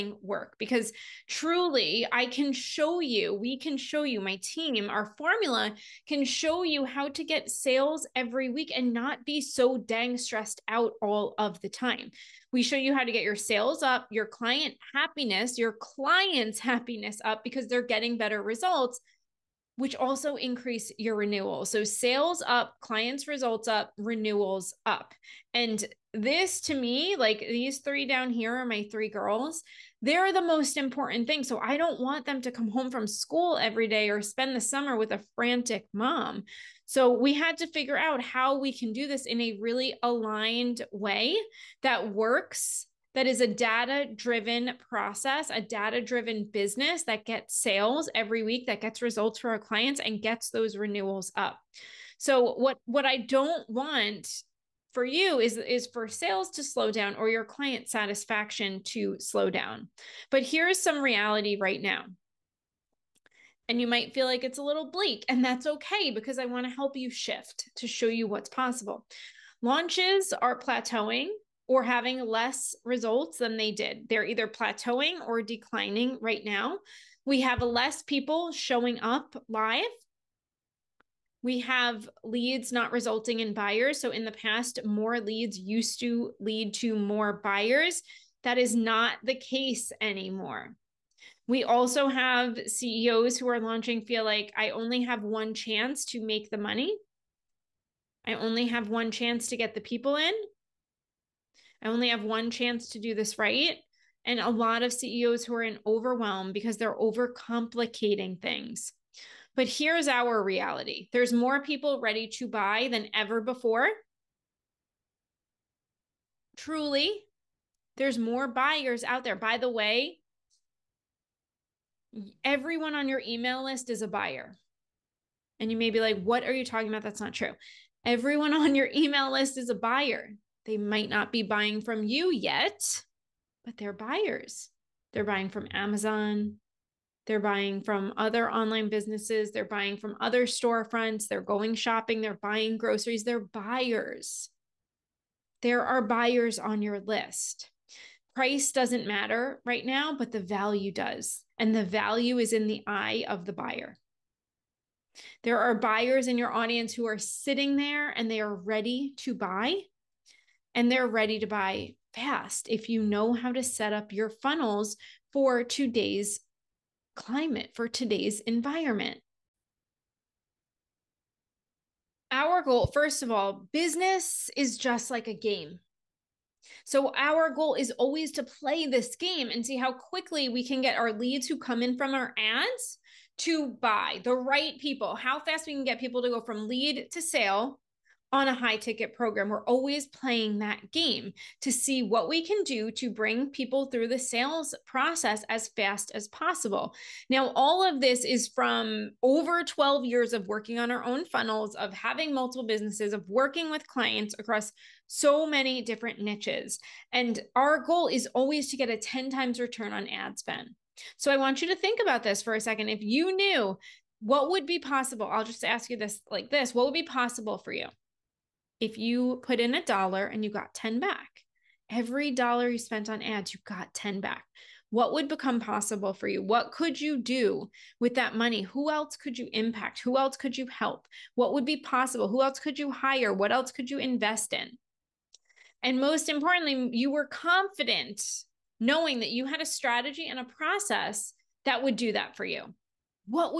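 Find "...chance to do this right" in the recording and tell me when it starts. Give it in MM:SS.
01:42.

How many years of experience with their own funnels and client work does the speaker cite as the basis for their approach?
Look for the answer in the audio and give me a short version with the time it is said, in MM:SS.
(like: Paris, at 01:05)
12 years, at 03:19.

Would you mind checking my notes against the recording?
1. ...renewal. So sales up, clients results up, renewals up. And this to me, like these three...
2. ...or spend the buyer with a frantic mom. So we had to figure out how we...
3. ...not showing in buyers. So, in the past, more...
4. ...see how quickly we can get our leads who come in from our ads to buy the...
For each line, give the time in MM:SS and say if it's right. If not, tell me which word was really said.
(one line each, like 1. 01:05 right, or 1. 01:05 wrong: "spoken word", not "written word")
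1. 00:21 right
2. 00:34 wrong: "summer", not "buyer"
3. 01:22 wrong: "resulting", not "showing"
4. 02:59 right.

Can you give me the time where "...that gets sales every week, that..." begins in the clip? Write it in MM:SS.
00:47.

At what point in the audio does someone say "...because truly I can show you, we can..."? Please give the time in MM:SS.
00:00.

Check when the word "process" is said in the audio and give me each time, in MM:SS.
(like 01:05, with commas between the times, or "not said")
00:44, 03:14, 04:00.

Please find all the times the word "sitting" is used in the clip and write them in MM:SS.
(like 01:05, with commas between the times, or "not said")
02:37.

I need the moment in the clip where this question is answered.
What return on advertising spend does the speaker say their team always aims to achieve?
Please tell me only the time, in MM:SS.
03:28.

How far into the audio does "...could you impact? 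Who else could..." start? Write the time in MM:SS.
03:49.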